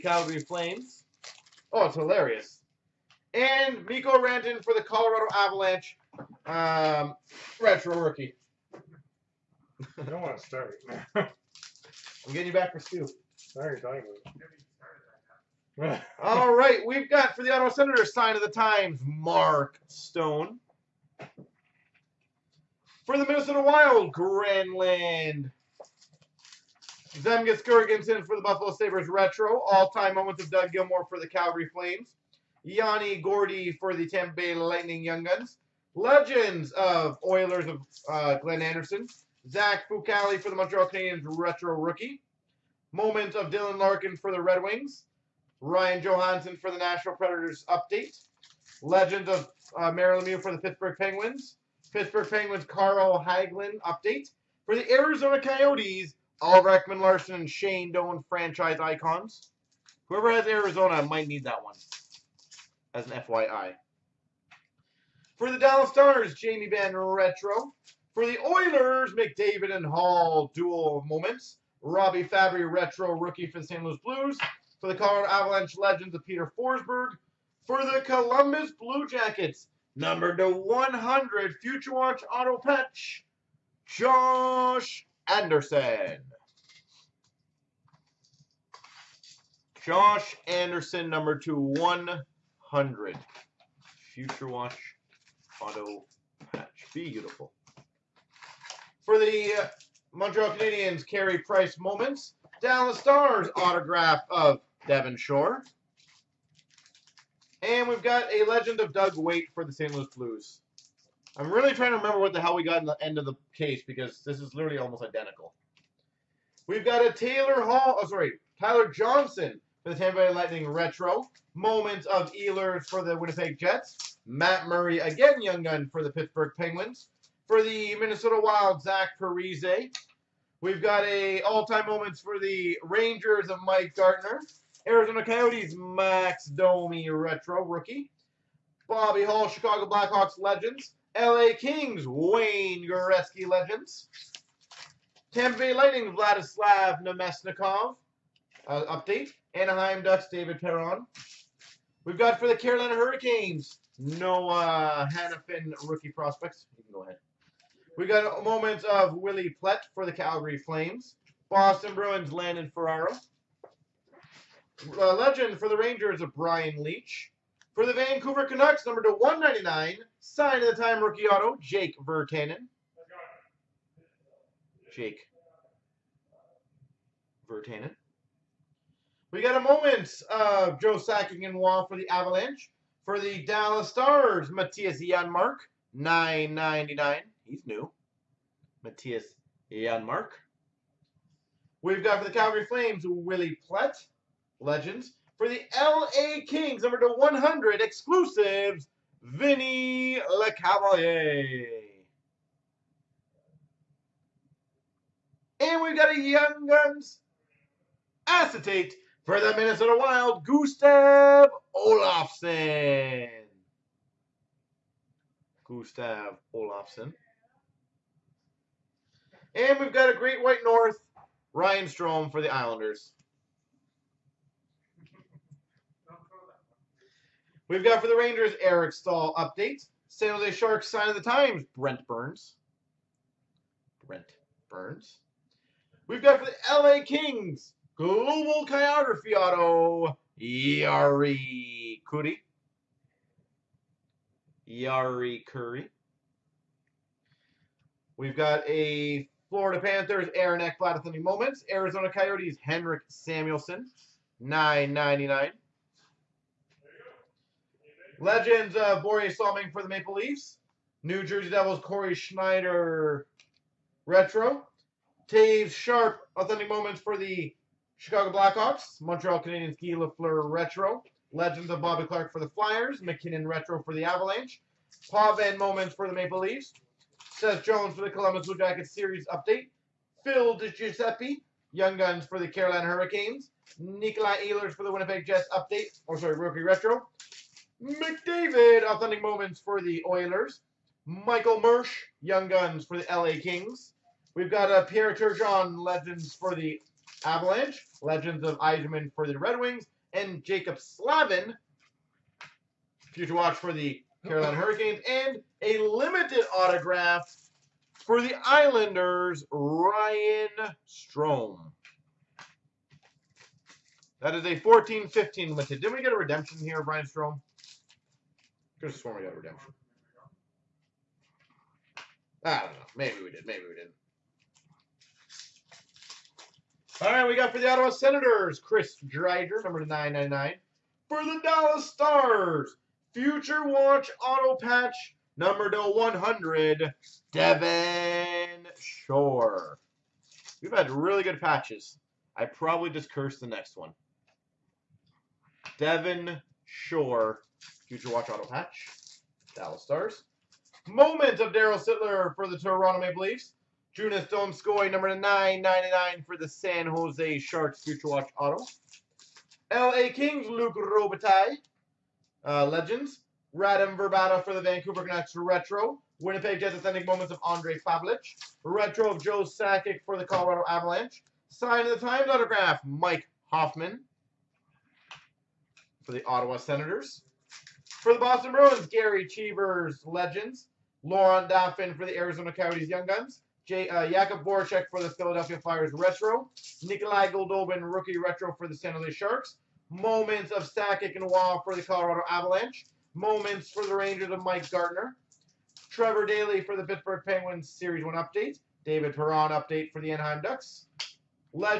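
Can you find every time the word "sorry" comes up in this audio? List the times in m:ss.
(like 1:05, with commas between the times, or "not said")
0:13, 1:58, 4:46.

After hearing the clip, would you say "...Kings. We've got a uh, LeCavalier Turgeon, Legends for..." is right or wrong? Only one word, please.
wrong.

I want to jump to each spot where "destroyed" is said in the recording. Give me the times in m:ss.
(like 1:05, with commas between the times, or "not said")
not said.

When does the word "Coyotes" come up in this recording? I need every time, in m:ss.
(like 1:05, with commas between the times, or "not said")
0:55, 2:15, 4:12, 6:22.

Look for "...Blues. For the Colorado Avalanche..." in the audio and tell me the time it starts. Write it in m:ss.
1:14.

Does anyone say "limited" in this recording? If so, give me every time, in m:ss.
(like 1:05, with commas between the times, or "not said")
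5:05, 5:15.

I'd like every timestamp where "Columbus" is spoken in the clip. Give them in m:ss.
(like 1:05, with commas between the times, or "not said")
1:18, 4:38.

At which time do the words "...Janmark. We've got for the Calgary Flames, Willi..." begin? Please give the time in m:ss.
3:09.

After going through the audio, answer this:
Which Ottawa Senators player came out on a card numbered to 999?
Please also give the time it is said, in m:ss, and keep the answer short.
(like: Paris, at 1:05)
Chris Driedger, at 5:28.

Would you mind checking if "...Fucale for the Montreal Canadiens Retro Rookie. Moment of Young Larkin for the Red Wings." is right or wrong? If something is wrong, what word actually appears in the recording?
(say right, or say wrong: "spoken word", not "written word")
wrong: "Dylan", not "Young".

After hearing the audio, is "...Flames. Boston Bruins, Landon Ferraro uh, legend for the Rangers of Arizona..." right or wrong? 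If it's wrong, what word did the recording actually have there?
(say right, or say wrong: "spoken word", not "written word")
wrong: "Brian", not "Arizona".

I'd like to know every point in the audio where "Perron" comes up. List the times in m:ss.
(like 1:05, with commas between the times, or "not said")
2:30, 6:39.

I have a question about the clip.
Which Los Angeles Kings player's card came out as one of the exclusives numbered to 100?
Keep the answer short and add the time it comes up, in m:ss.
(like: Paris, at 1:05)
Vinny LeCavalier, at 3:19.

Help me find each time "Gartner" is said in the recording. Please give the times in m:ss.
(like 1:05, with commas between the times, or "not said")
2:13, 6:34.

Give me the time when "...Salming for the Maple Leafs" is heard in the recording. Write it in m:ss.
4:19.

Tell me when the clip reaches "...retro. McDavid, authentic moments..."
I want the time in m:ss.
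4:46.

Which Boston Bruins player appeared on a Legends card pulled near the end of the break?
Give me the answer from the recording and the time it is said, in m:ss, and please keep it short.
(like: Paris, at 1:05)
Gerry Cheevers, at 6:18.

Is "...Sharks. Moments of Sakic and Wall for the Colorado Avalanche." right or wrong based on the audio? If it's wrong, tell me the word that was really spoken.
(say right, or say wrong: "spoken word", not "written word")
right.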